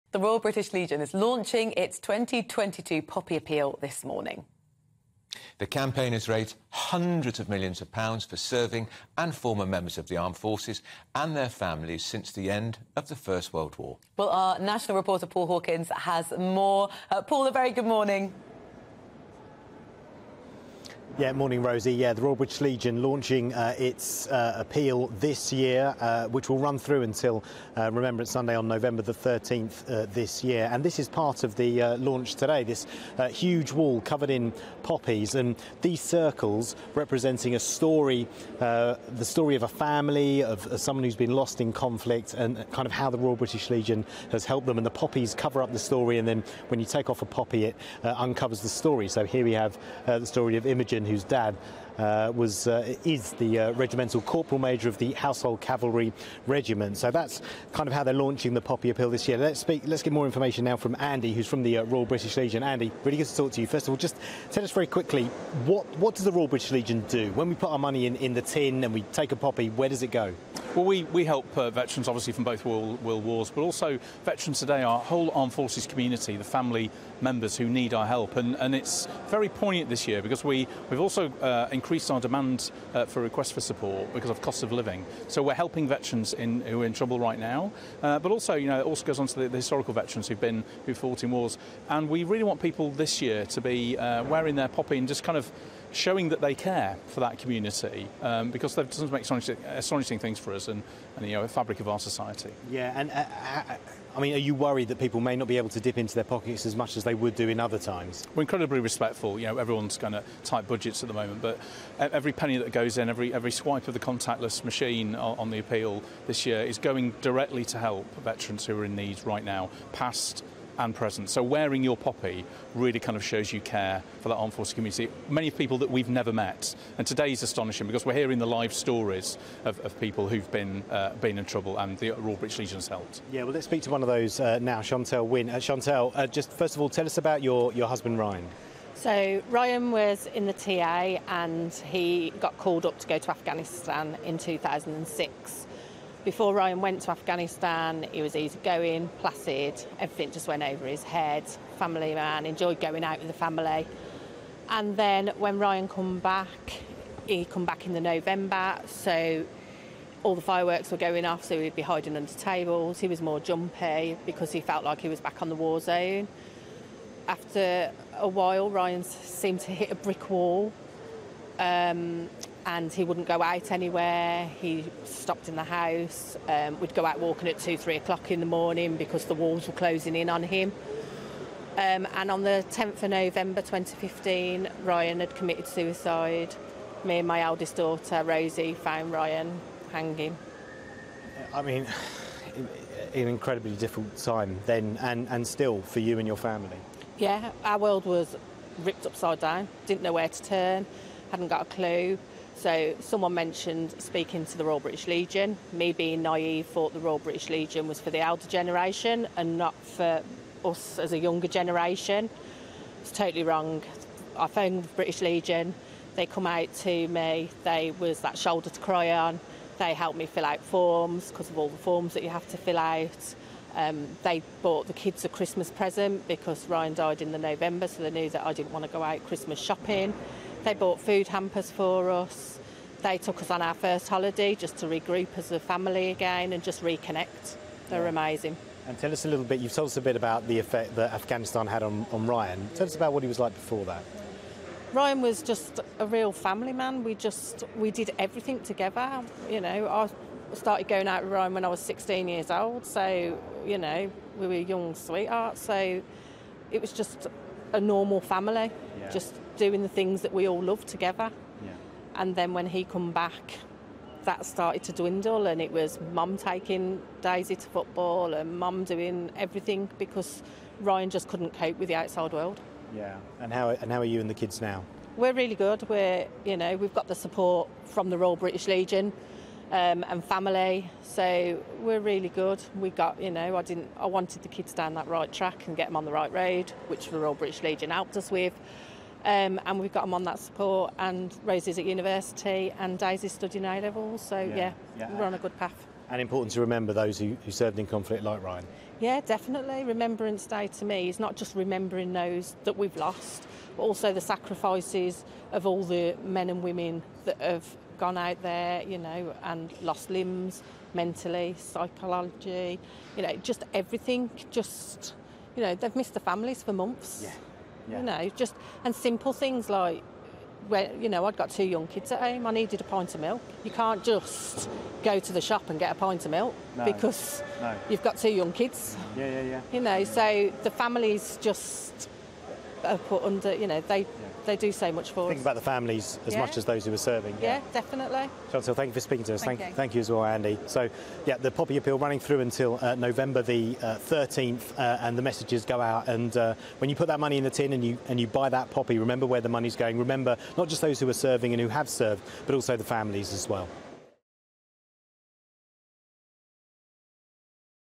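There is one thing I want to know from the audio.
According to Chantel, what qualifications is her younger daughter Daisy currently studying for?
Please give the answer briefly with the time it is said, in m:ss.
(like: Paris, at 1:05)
A levels, at 4:53.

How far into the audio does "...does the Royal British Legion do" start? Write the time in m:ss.
1:06.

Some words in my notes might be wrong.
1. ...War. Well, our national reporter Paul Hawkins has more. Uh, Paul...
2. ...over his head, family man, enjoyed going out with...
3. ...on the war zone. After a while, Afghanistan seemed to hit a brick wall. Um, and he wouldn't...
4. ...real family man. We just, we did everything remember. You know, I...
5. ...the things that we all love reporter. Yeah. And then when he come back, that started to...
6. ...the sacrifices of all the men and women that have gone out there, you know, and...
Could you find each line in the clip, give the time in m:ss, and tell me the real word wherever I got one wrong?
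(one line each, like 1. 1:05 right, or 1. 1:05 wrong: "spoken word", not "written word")
1. 0:13 right
2. 2:30 right
3. 2:45 wrong: "Ryan", not "Afghanistan"
4. 4:06 wrong: "together", not "remember"
5. 4:19 wrong: "together", not "reporter"
6. 5:04 right.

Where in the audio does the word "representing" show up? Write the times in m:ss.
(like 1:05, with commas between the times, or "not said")
0:36.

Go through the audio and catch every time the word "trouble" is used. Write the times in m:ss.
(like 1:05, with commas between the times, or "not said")
1:26, 2:11.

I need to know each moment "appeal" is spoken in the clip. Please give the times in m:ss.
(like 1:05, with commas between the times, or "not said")
0:03, 0:24, 0:58, 1:55, 5:41.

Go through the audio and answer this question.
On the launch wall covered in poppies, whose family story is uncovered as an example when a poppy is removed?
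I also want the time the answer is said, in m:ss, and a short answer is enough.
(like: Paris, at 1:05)
Imogen, at 0:50.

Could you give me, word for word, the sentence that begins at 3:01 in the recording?
Um, and on the 10th of November 2015, Ryan had committed suicide.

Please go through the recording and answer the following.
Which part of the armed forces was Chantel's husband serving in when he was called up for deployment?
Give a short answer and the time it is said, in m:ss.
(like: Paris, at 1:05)
TA, at 2:20.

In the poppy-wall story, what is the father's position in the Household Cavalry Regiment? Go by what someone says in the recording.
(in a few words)
Regimental corporal major.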